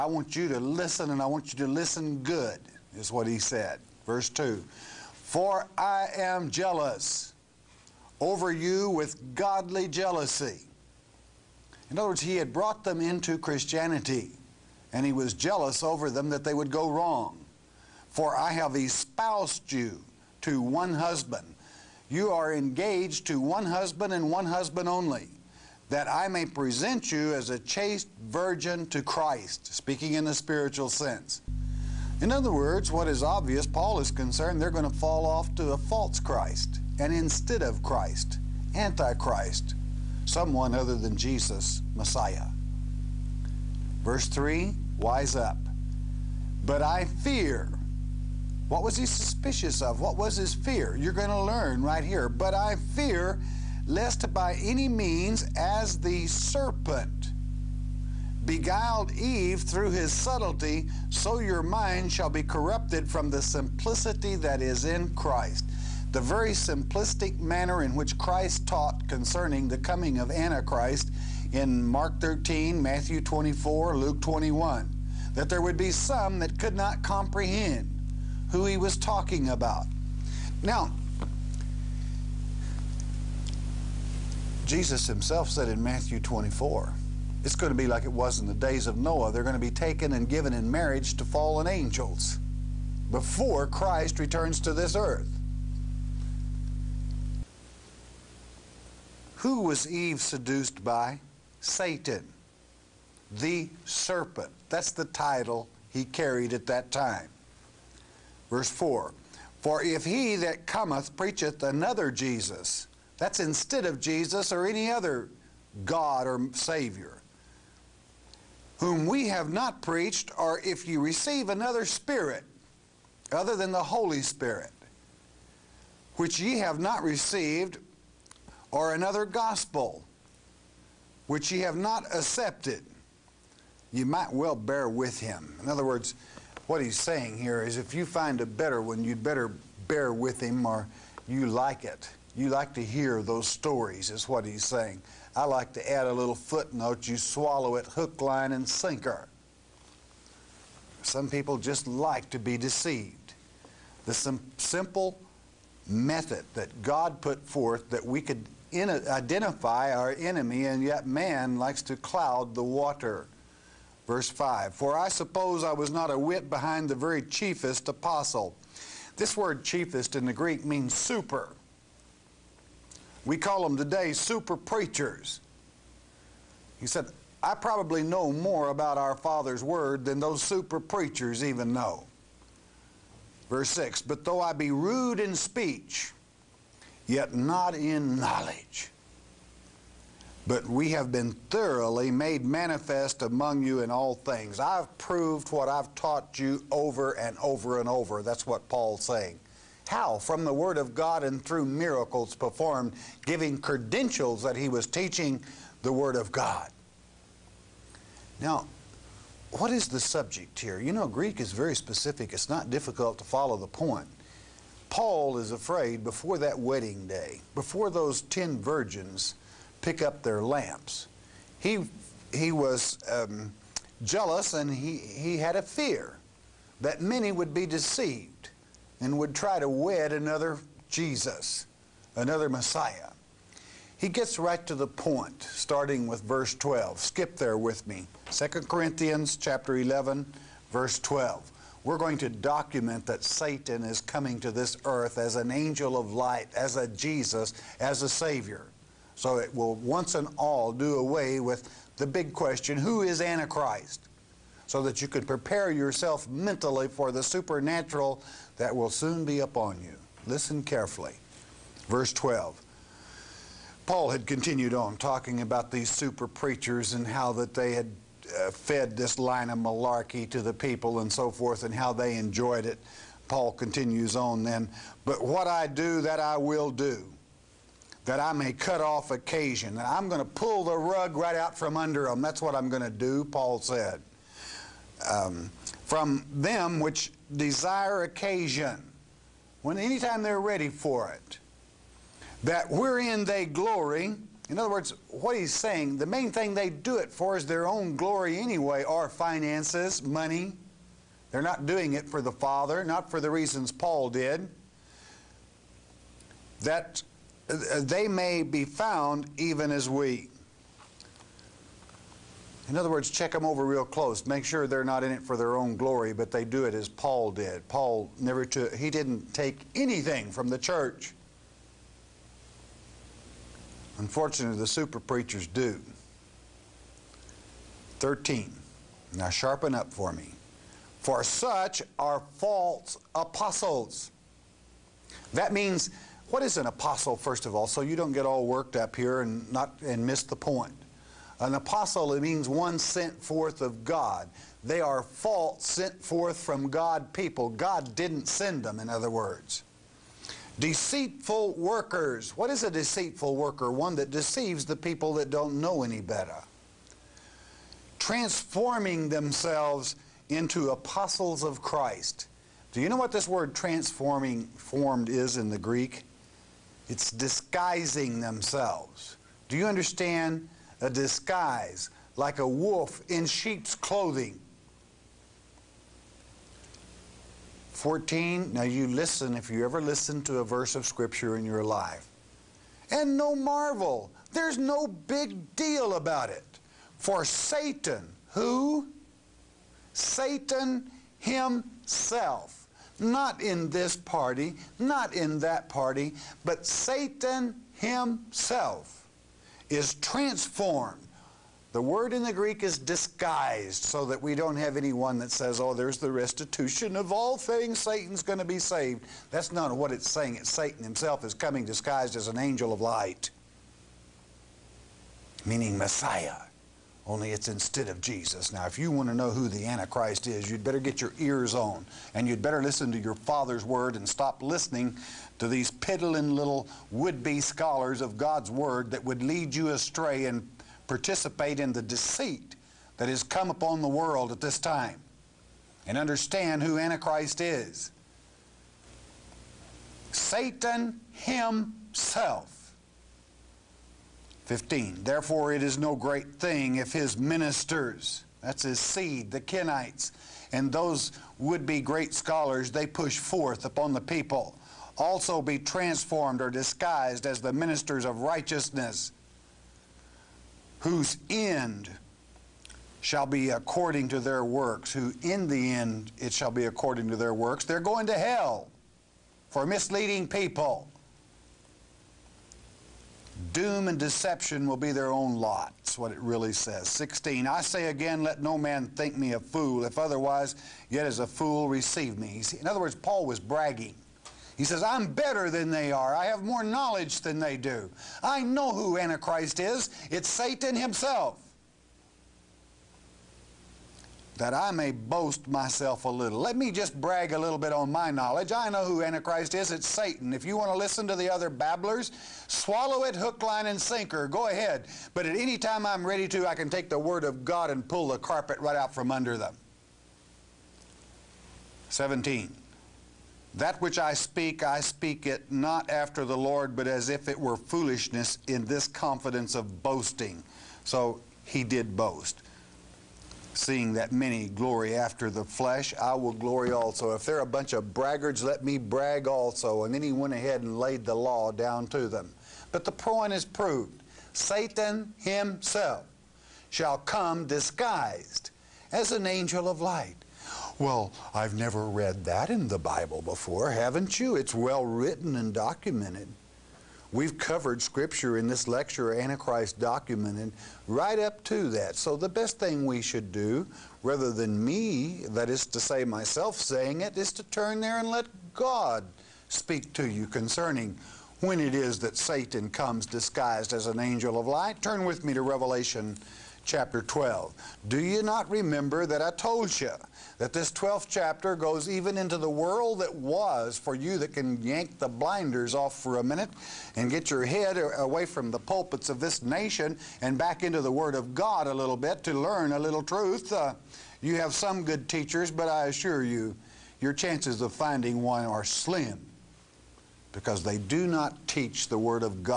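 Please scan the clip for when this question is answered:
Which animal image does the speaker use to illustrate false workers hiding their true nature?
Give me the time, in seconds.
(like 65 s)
372 s.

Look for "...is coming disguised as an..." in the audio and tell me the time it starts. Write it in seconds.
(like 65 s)
411 s.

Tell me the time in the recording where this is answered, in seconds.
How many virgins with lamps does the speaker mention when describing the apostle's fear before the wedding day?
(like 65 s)
218 s.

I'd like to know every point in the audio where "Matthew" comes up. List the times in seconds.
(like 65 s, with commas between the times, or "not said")
72 s, 85 s.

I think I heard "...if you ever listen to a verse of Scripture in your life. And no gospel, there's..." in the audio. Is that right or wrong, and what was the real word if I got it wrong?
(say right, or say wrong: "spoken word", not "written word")
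wrong: "marvel", not "gospel".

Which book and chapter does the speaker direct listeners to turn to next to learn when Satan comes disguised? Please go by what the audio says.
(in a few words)
Revelation chapter 12.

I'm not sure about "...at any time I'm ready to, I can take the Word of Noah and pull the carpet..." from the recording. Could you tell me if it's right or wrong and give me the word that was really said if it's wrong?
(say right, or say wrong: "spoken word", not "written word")
wrong: "God", not "Noah".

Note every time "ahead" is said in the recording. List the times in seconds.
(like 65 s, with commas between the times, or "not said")
504 s, 530 s.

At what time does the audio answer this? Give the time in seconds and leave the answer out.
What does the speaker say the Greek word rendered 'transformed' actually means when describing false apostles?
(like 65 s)
367 s.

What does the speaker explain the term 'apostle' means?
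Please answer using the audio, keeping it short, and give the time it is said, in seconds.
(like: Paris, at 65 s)
One sent forth of God, at 342 s.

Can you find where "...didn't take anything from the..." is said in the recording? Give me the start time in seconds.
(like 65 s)
318 s.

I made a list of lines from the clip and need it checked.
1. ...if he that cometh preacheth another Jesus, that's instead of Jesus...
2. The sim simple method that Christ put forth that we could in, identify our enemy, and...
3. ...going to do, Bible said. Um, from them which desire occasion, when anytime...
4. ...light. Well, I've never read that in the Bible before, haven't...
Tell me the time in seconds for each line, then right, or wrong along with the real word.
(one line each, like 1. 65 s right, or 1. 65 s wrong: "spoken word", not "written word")
1. 109 s right
2. 154 s wrong: "God", not "Christ"
3. 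282 s wrong: "Paul", not "Bible"
4. 539 s right.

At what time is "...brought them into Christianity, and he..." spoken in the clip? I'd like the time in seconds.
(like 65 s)
12 s.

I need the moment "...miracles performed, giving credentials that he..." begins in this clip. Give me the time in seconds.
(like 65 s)
201 s.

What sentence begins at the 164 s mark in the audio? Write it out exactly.
Verse 5 For I suppose I was not a whit behind the very chiefest apostle.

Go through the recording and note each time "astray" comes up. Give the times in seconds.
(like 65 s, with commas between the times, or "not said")
429 s.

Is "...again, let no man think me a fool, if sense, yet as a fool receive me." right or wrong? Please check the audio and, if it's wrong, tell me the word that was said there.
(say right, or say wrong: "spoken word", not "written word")
wrong: "otherwise", not "sense".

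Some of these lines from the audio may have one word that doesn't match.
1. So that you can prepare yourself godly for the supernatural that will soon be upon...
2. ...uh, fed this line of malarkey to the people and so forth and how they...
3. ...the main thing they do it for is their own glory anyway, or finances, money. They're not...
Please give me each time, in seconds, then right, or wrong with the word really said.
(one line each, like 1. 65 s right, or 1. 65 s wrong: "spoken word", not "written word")
1. 254 s wrong: "mentally", not "godly"
2. 268 s right
3. 295 s right.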